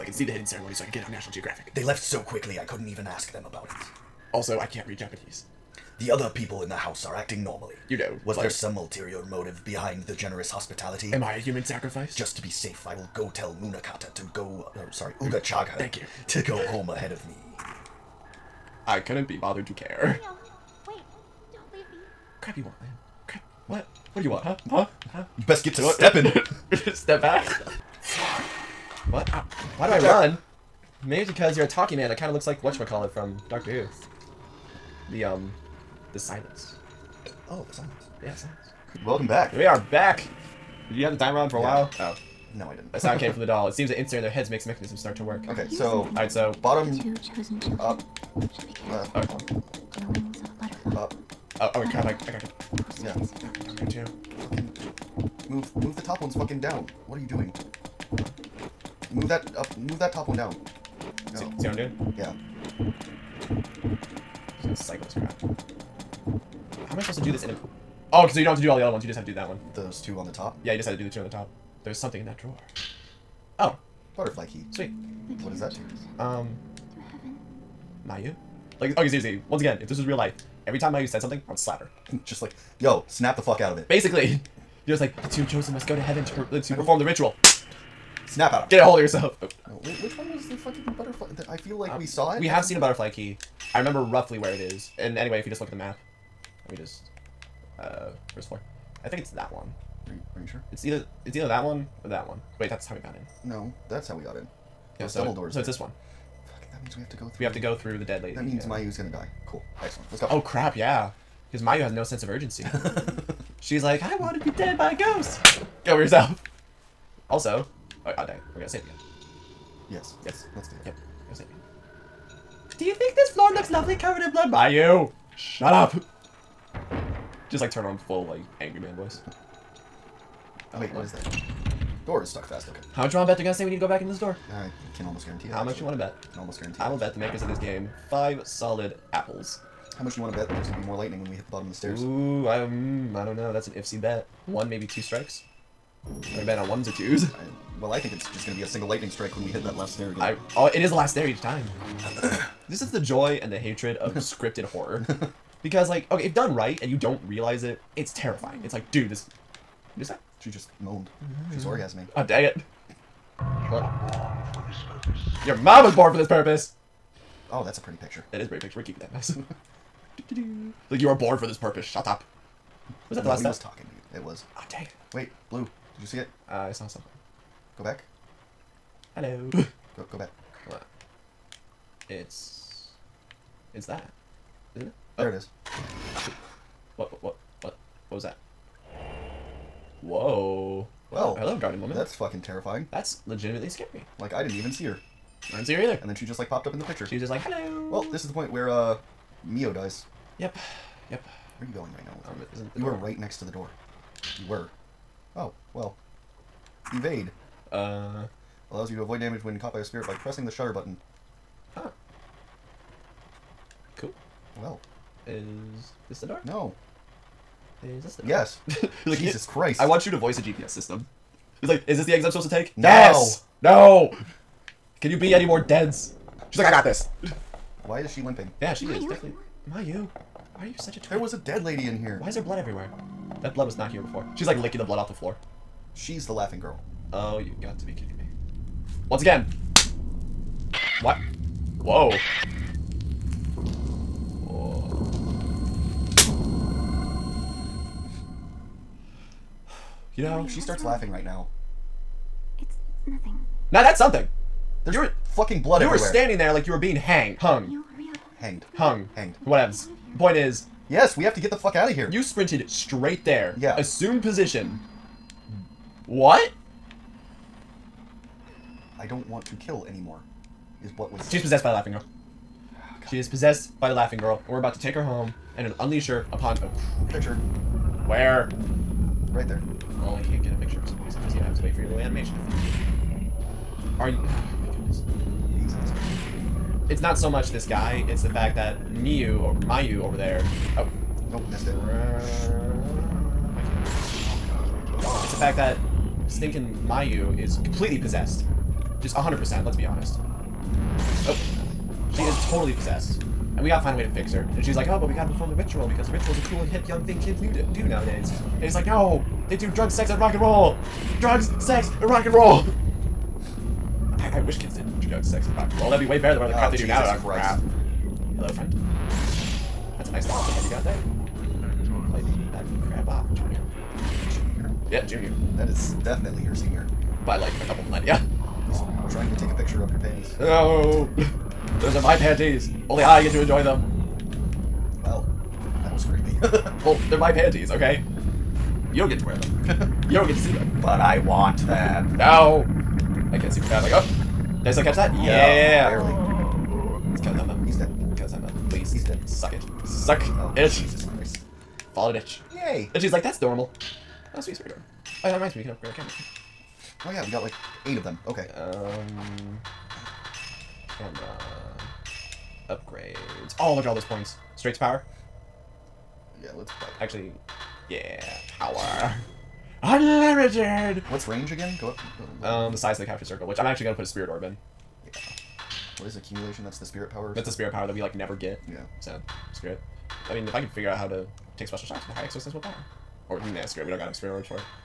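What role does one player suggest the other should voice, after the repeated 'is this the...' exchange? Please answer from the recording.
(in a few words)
a GPS system.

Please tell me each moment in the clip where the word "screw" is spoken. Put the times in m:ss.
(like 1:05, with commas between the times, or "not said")
6:19, 6:23.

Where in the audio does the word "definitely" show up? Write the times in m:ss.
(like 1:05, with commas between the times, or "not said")
3:49, 5:26.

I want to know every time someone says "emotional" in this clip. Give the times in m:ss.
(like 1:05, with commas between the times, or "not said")
not said.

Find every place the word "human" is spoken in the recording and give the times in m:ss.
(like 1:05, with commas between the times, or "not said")
0:11.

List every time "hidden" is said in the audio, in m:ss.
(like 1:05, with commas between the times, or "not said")
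0:00.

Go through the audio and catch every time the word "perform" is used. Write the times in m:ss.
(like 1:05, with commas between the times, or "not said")
1:26, 5:05.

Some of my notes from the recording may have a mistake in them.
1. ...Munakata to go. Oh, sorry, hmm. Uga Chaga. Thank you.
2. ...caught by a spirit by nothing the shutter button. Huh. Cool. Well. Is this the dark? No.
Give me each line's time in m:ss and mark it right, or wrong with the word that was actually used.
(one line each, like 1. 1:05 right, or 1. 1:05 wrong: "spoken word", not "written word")
1. 0:13 right
2. 3:29 wrong: "pressing", not "nothing".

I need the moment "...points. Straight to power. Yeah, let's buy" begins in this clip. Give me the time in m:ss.
6:04.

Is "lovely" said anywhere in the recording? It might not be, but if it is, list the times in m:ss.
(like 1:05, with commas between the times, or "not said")
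2:03.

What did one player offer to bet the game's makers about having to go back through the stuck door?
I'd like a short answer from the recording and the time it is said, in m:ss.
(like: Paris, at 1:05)
five solid apples, at 2:18.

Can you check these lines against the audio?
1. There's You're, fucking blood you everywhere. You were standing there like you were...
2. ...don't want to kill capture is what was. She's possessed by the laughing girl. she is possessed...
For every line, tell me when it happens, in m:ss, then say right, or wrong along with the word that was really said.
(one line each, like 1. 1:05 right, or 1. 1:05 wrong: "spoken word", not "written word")
1. 4:14 right
2. 4:29 wrong: "anymore", not "capture".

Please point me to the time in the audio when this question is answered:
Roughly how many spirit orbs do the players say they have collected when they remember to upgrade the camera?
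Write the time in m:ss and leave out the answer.
5:57.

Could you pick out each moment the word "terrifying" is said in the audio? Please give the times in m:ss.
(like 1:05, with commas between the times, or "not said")
2:38, 3:12.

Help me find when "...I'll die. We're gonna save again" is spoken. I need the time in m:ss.
1:58.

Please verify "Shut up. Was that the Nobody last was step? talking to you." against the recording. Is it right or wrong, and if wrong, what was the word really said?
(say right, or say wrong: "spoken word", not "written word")
right.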